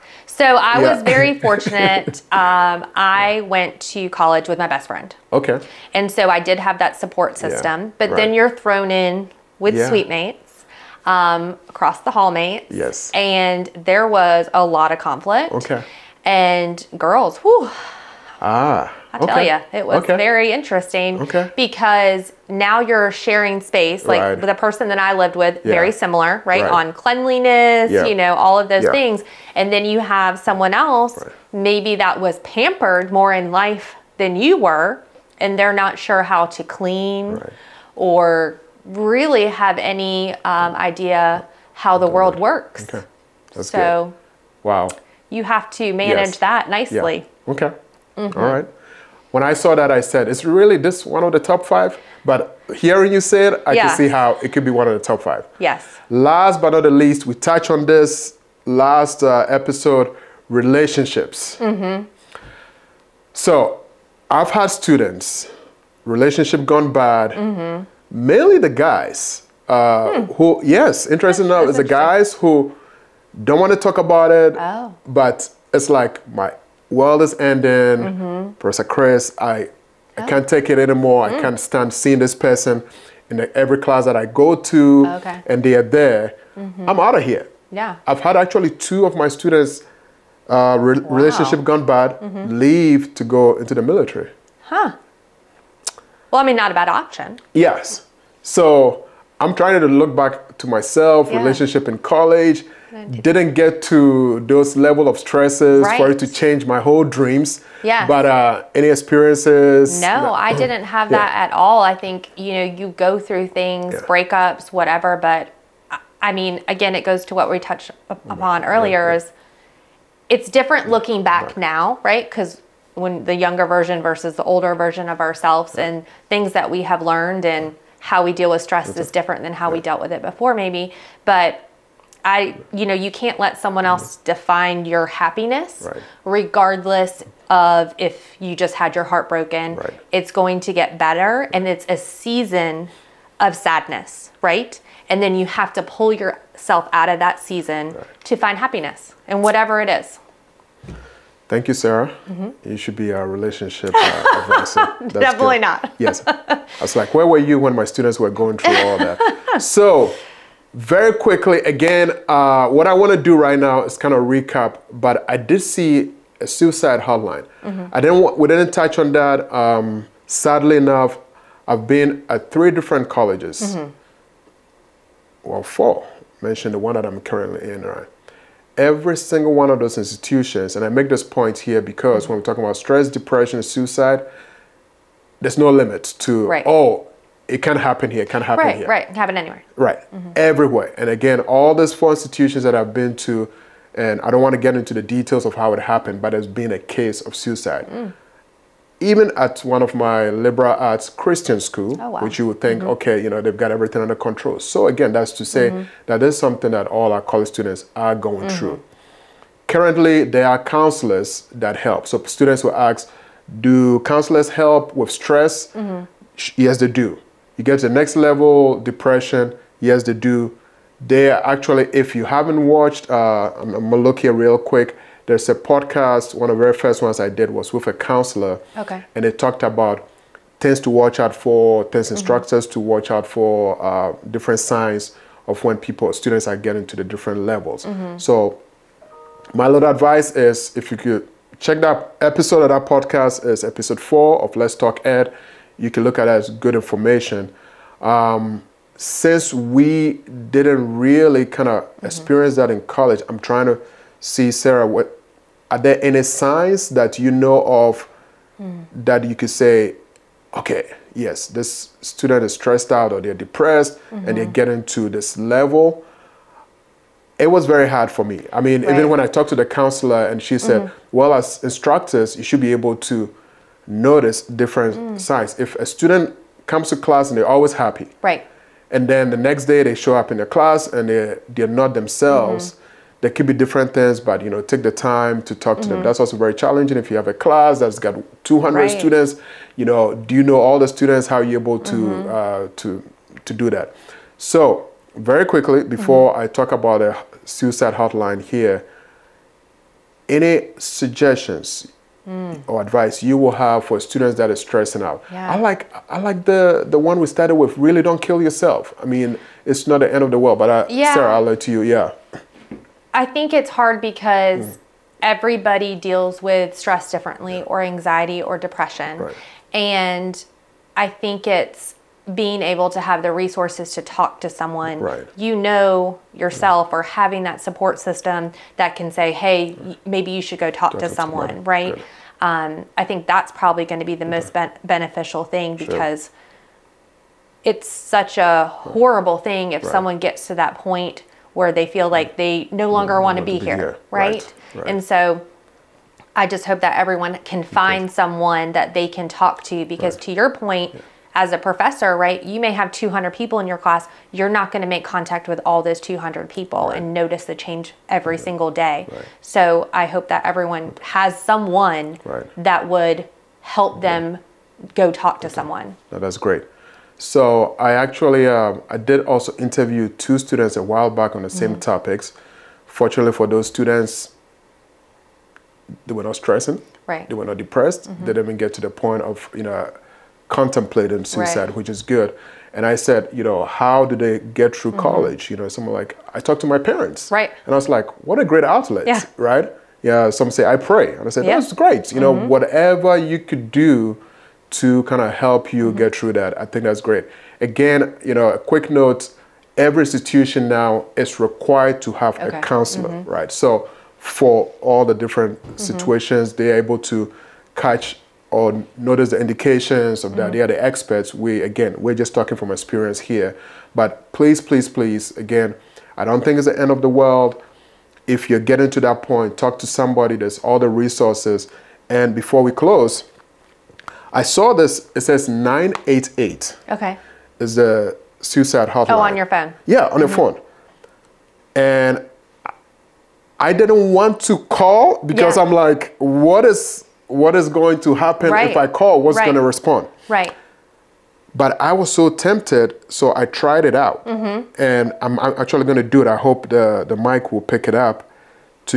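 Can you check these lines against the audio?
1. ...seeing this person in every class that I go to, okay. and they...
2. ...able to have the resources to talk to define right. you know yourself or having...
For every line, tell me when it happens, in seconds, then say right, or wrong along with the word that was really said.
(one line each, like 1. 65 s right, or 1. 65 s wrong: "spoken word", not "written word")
1. 81 s right
2. 322 s wrong: "someone", not "define".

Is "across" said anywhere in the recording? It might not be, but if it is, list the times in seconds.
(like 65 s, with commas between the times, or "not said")
11 s.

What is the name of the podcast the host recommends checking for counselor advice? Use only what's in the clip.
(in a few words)
Let's Talk Ed.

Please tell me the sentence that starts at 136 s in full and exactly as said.
regardless of if you just had your heart broken.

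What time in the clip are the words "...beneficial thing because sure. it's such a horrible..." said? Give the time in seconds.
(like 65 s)
334 s.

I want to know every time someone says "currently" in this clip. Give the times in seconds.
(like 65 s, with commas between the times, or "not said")
177 s, 209 s.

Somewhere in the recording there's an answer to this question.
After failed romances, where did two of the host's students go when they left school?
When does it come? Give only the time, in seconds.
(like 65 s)
93 s.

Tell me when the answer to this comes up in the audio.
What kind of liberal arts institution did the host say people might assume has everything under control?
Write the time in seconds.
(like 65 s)
201 s.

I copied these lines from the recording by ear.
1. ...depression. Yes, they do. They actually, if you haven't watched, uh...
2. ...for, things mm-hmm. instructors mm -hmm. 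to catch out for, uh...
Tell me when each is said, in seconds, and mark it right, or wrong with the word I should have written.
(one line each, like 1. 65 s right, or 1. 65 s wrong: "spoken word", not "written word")
1. 218 s right
2. 231 s wrong: "watch", not "catch".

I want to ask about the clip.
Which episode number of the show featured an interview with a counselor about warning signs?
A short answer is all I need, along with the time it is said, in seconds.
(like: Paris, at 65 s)
4, at 243 s.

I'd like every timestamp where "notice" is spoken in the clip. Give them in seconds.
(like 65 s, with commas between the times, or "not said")
273 s, 357 s, 408 s.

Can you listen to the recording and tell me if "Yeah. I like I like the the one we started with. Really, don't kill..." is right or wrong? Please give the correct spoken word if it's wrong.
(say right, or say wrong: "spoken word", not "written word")
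right.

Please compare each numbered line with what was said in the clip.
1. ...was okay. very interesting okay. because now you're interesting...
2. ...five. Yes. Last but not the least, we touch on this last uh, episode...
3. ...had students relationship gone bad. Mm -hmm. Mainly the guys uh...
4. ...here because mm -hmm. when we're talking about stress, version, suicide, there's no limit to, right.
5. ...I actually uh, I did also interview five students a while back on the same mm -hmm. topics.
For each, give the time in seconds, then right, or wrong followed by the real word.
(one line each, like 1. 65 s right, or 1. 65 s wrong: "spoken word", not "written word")
1. 19 s wrong: "sharing", not "interesting"
2. 55 s right
3. 64 s right
4. 181 s wrong: "depression", not "version"
5. 367 s wrong: "two", not "five".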